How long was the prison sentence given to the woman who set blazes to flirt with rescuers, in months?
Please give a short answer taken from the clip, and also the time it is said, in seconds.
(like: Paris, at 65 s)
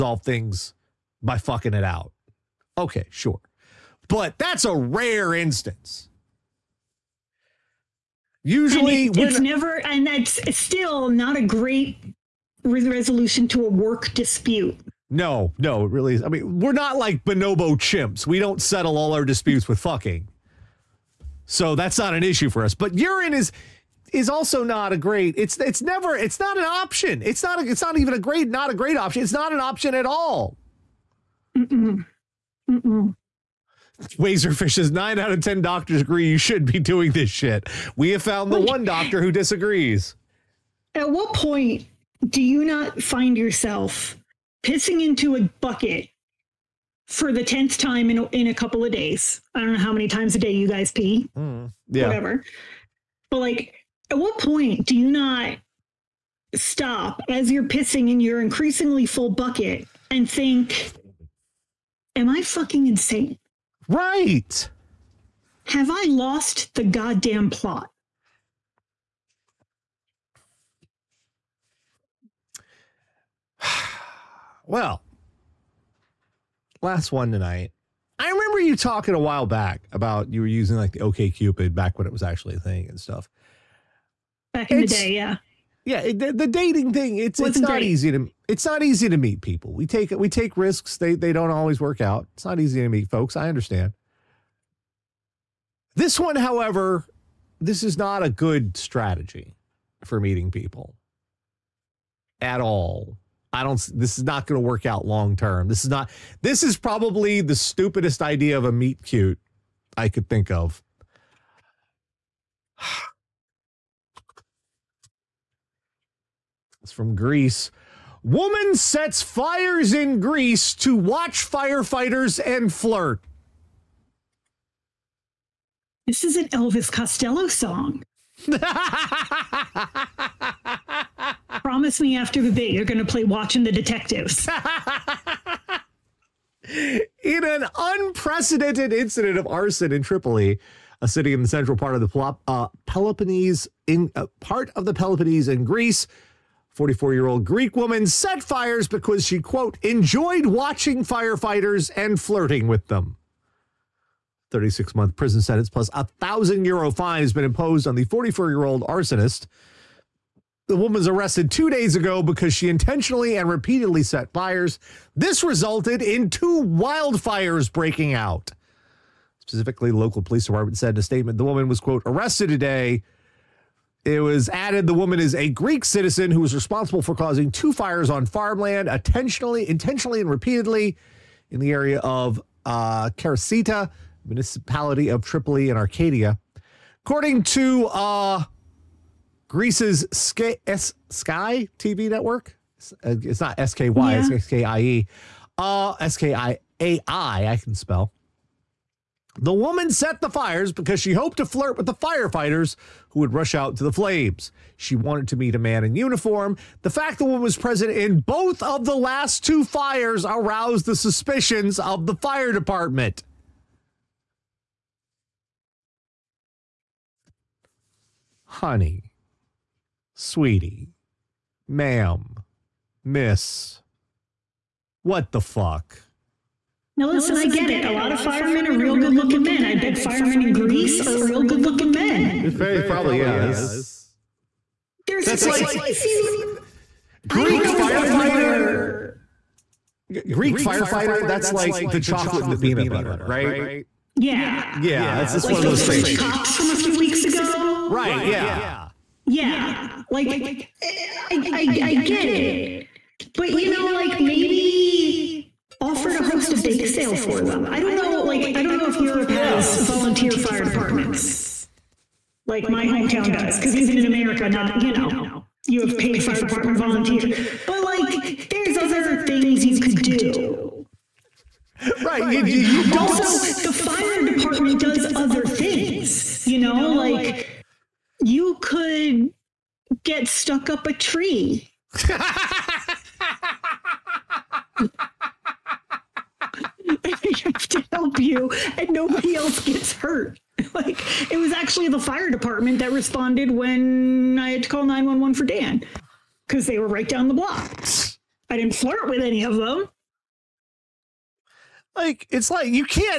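36 months, at 154 s.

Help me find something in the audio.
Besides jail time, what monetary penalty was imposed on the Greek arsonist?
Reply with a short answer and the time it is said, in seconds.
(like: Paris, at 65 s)
1000 euros, at 155 s.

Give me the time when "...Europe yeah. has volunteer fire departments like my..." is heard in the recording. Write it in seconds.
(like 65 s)
258 s.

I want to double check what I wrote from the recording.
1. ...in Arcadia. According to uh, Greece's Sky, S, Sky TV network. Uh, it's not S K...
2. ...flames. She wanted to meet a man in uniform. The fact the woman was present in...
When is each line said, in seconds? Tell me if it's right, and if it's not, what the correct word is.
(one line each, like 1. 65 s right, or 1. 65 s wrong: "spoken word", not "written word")
1. 185 s right
2. 203 s right.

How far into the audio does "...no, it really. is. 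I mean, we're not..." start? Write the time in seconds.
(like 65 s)
15 s.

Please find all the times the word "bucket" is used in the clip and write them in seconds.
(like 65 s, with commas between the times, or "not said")
45 s, 59 s.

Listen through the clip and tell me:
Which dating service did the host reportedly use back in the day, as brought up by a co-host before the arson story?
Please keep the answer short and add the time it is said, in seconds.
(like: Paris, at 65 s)
OkCupid, at 80 s.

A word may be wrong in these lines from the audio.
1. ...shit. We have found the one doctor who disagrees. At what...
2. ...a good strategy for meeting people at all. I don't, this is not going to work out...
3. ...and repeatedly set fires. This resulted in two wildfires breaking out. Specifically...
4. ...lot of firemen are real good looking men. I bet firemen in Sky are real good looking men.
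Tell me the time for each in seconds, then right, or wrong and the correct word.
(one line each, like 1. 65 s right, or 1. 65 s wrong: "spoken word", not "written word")
1. 37 s right
2. 98 s right
3. 163 s right
4. 227 s wrong: "Greece", not "Sky".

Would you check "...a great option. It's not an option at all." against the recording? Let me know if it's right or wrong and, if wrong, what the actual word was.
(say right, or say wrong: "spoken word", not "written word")
right.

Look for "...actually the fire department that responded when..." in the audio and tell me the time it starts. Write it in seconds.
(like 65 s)
291 s.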